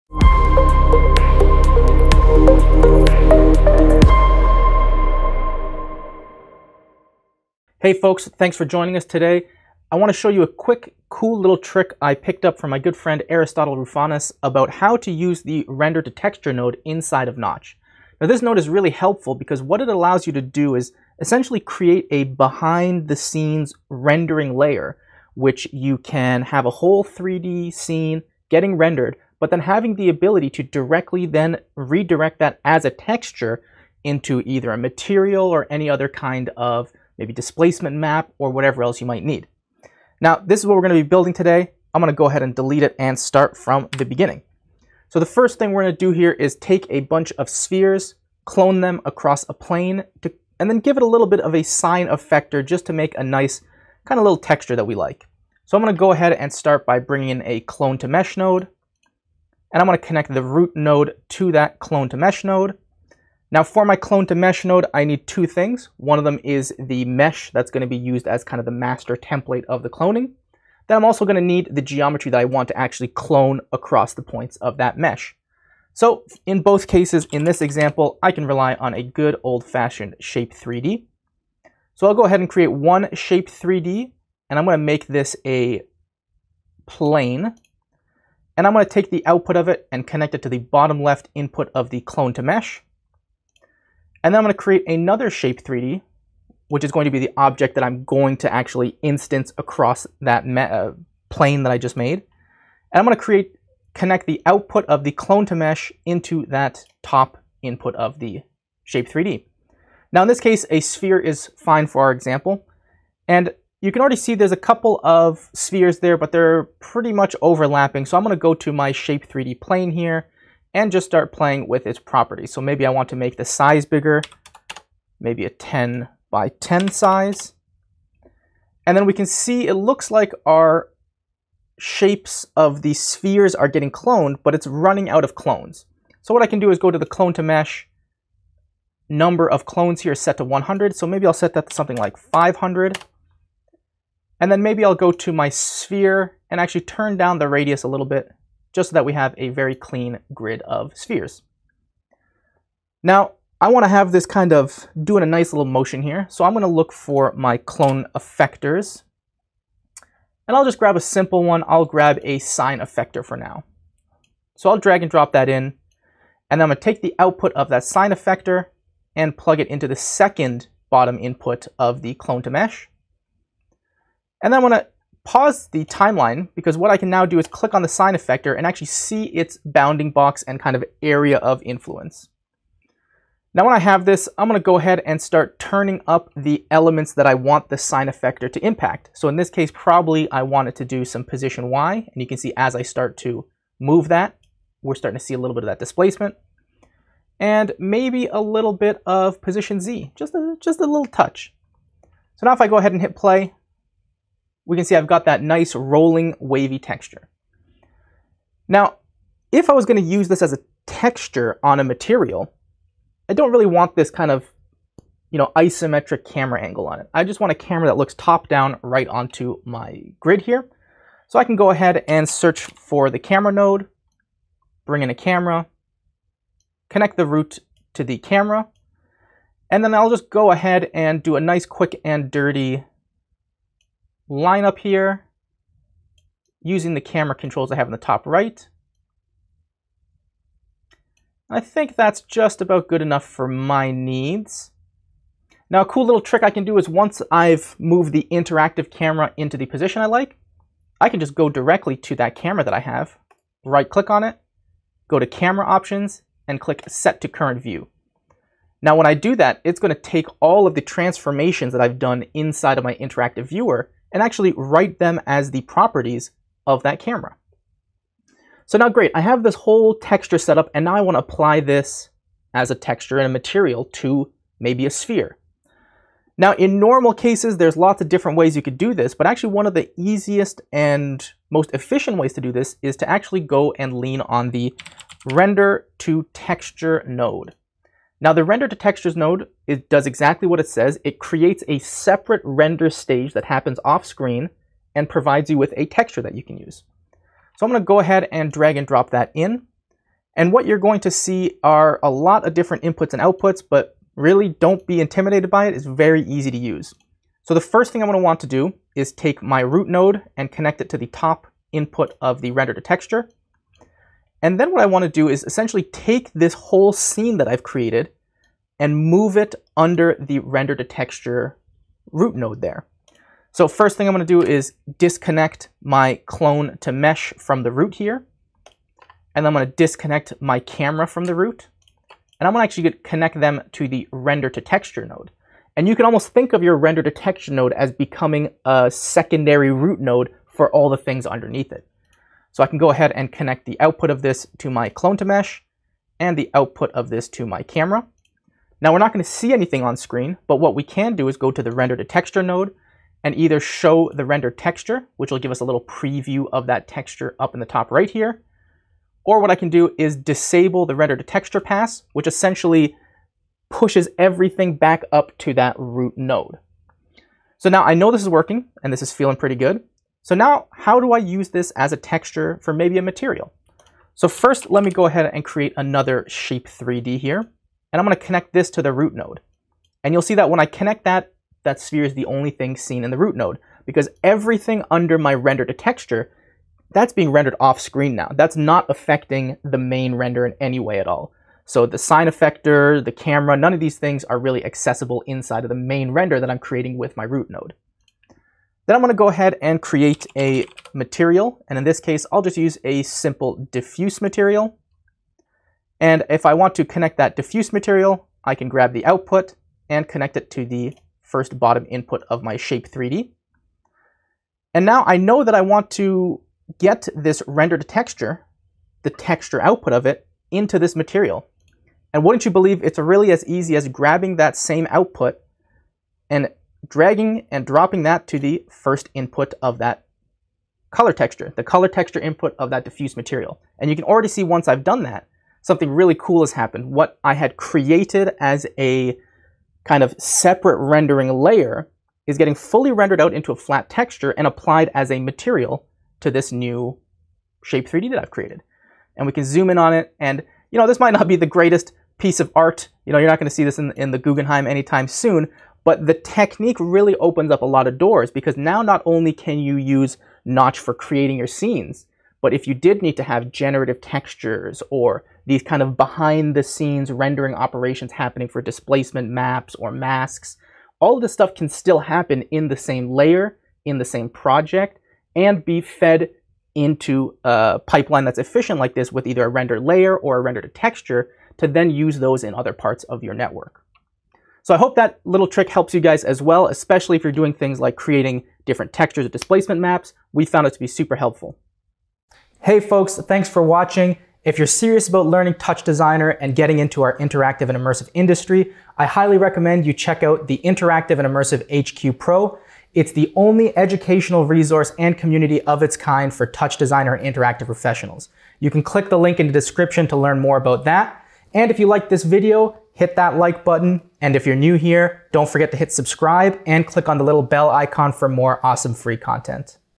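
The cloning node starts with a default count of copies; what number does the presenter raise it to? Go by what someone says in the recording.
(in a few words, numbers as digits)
500.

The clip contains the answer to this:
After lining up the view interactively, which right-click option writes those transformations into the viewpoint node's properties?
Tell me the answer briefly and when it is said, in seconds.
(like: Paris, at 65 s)
set to current view, at 256 s.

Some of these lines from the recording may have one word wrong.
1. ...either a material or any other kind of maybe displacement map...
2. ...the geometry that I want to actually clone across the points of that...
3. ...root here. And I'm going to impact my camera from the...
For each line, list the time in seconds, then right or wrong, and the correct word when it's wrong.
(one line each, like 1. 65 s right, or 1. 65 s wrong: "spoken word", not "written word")
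1. 34 s right
2. 71 s right
3. 327 s wrong: "disconnect", not "impact".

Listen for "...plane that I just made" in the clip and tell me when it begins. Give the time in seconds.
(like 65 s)
101 s.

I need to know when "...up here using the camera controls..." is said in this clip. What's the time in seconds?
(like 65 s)
234 s.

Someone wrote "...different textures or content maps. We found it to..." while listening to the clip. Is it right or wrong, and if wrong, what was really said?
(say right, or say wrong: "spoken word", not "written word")
wrong: "displacement", not "content".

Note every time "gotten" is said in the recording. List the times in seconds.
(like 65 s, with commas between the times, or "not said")
not said.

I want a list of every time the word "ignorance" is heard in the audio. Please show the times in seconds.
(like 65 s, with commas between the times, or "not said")
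not said.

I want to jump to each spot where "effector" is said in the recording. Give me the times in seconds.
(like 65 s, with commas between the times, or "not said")
52 s, 158 s, 162 s, 168 s, 178 s, 188 s, 392 s.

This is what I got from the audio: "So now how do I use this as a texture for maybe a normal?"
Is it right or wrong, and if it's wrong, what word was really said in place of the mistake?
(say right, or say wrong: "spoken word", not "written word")
wrong: "material", not "normal".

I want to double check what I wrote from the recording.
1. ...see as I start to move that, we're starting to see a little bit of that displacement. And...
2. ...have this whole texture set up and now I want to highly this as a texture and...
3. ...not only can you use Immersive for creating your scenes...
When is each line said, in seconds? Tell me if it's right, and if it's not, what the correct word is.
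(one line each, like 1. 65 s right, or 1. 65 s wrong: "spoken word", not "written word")
1. 192 s right
2. 269 s wrong: "apply", not "highly"
3. 458 s wrong: "Notch", not "Immersive".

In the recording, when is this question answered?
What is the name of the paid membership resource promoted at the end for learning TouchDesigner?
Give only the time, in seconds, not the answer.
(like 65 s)
500 s.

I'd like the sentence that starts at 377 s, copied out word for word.
And I'm gonna connect this to the root node.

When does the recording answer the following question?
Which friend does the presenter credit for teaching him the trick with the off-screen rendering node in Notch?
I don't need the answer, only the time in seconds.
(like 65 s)
13 s.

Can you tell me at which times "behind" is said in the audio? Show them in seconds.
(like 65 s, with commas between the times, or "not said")
22 s, 465 s.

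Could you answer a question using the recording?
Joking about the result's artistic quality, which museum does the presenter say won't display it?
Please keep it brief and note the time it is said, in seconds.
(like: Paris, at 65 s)
Guggenheim, at 454 s.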